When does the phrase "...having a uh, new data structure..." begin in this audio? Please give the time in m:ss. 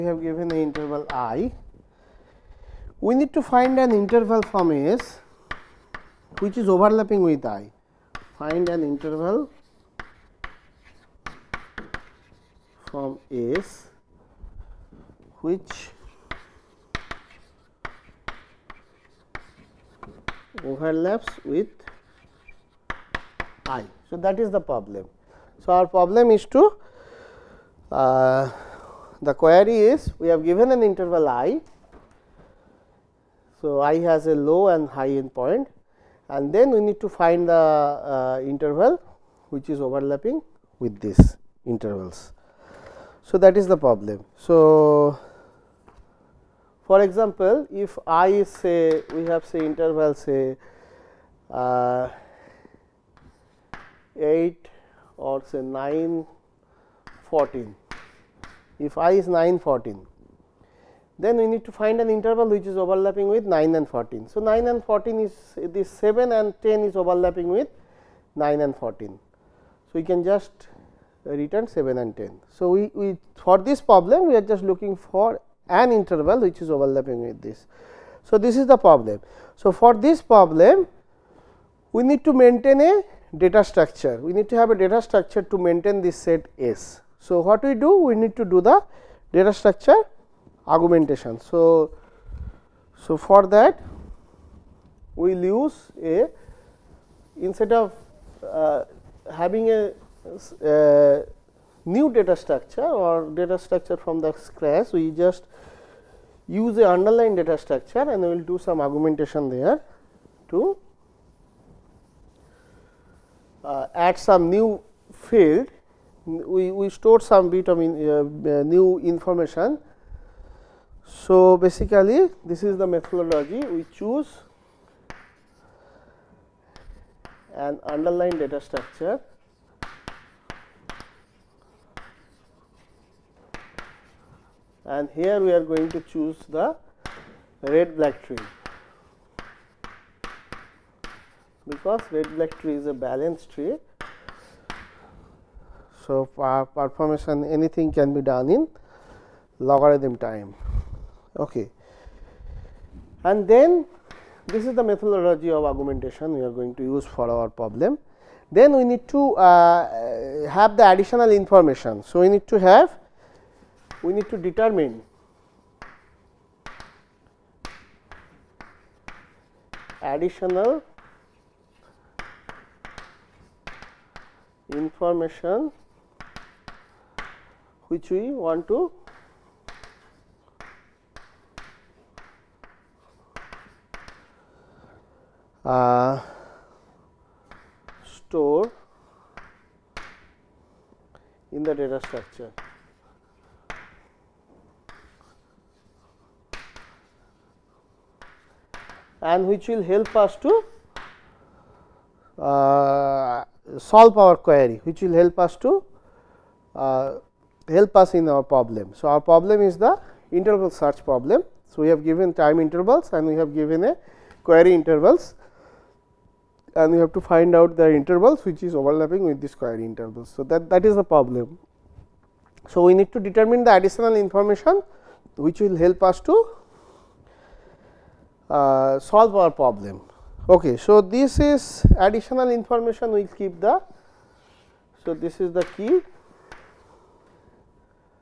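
1:39.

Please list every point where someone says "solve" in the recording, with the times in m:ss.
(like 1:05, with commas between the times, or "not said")
3:23, 3:48.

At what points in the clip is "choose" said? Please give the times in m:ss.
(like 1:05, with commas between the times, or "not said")
2:03, 2:15.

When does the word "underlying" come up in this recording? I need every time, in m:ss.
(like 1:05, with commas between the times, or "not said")
1:46, 2:07.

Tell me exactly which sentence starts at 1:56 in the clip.
We, we store some bit of in, uh, uh new information.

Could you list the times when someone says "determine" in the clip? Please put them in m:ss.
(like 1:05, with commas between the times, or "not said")
2:44, 3:43.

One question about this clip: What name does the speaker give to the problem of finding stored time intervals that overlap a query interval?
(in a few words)
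Interval search problem.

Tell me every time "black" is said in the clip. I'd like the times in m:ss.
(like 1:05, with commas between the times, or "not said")
2:17, 2:22.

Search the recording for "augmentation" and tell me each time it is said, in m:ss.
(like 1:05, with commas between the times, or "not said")
1:30, 1:48, 2:35.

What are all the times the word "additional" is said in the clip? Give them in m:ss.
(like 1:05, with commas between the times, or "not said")
2:40, 2:49, 3:43, 3:51.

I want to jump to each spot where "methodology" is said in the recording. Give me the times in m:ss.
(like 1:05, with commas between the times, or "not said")
2:02, 2:34.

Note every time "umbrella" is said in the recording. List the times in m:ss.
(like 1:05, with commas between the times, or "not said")
not said.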